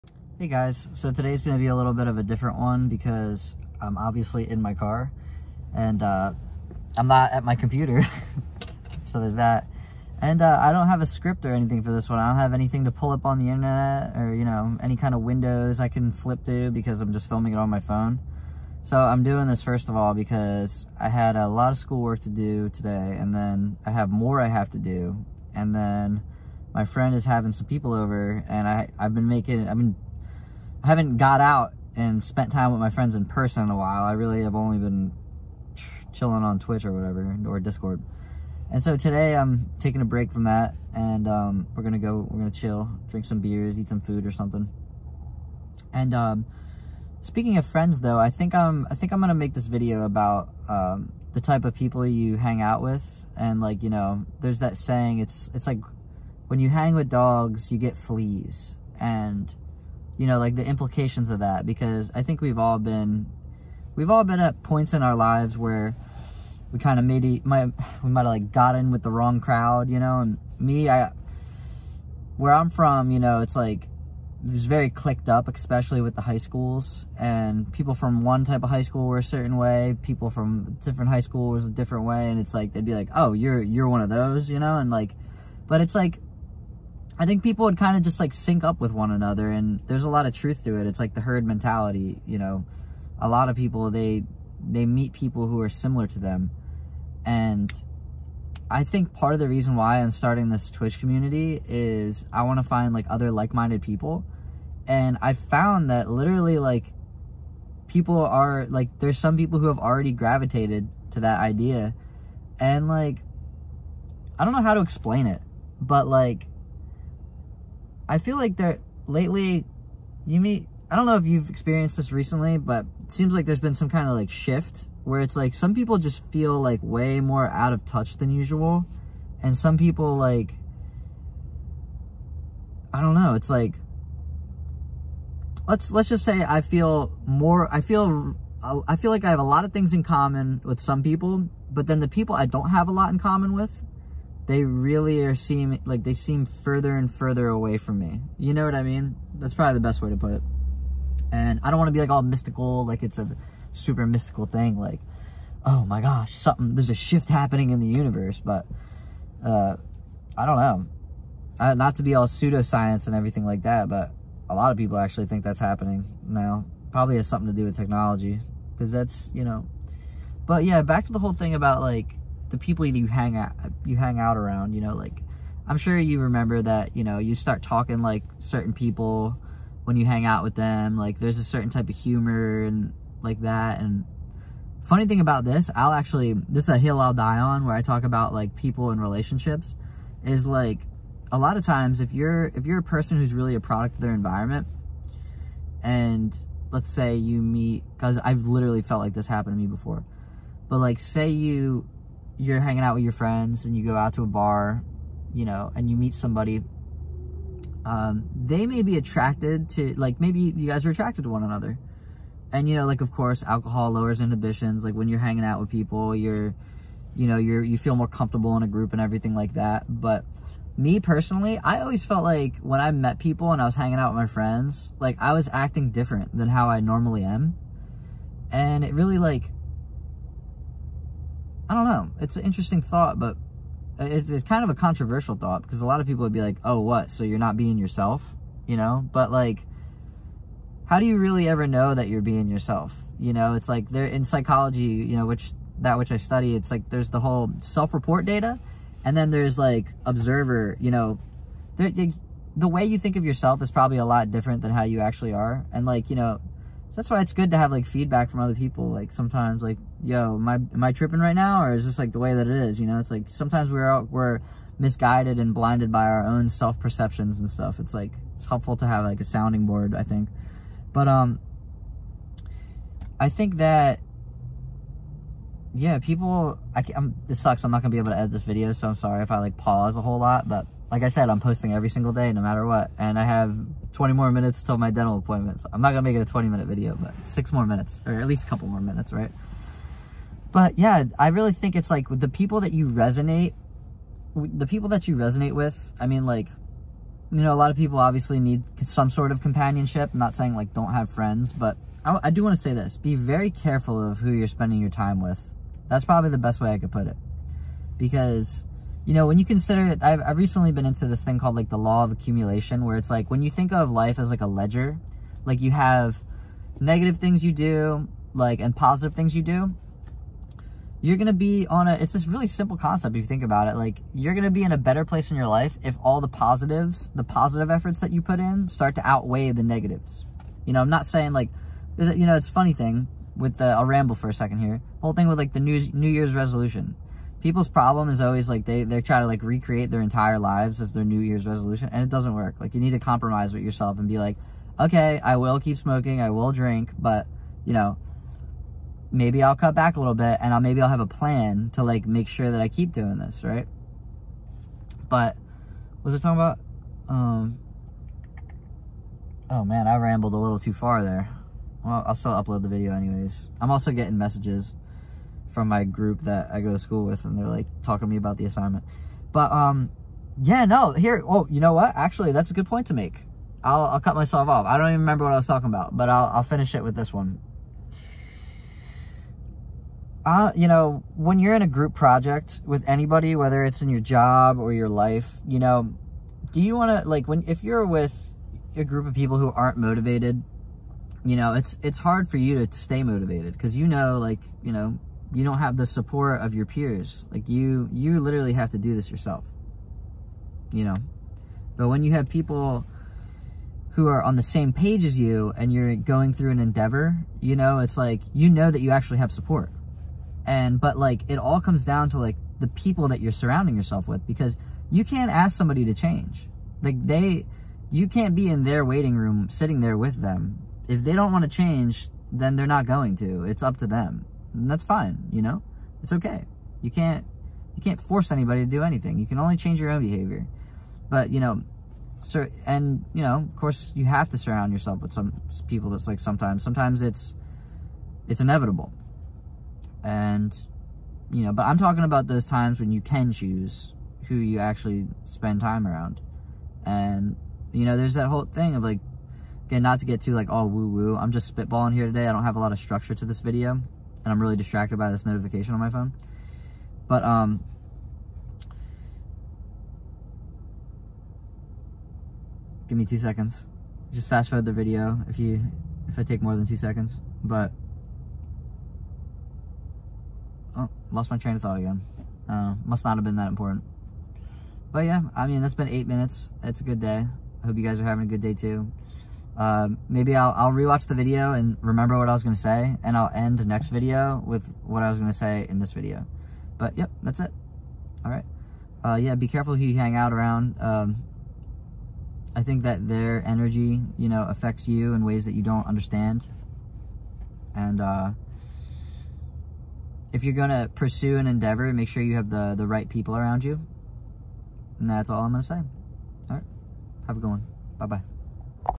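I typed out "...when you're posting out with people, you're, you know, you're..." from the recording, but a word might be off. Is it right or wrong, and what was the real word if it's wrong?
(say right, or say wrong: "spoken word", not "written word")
wrong: "hanging", not "posting".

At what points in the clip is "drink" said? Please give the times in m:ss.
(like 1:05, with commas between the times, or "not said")
0:43, 5:46.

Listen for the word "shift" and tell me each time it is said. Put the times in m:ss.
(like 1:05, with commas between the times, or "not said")
2:04, 2:36.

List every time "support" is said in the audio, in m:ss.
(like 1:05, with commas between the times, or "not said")
6:35, 6:49.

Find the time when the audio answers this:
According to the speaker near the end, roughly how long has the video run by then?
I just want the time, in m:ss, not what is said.
7:55.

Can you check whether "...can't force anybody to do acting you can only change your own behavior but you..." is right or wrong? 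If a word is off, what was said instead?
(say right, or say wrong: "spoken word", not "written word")
wrong: "anything", not "acting".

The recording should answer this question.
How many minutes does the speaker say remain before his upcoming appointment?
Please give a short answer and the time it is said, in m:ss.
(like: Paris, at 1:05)
20, at 4:43.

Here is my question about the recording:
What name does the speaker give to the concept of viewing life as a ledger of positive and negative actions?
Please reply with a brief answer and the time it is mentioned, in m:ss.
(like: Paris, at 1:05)
Law of accumulation, at 5:11.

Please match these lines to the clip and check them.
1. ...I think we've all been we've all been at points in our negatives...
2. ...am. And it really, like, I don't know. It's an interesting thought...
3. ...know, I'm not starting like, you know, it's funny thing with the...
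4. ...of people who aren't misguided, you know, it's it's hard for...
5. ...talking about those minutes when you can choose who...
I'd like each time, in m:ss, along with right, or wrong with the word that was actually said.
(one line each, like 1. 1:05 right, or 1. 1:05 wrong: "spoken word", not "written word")
1. 1:02 wrong: "lives", not "negatives"
2. 3:47 right
3. 5:30 wrong: "saying", not "starting"
4. 6:29 wrong: "motivated", not "misguided"
5. 7:21 wrong: "times", not "minutes".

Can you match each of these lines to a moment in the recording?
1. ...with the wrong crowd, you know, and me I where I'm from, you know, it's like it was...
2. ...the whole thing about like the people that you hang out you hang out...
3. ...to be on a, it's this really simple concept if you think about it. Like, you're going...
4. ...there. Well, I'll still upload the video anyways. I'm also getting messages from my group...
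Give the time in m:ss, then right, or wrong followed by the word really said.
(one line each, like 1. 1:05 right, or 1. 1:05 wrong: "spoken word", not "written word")
1. 1:08 right
2. 2:51 right
3. 5:21 right
4. 6:01 right.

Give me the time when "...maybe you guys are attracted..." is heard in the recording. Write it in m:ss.
3:30.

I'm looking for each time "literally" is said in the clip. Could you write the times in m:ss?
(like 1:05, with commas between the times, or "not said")
1:46, 3:18, 6:38.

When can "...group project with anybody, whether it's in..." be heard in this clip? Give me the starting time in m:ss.
6:21.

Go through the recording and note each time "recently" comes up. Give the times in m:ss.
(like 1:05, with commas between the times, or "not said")
2:02, 5:10.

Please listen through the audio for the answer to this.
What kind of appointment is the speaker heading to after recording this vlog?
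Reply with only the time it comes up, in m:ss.
4:44.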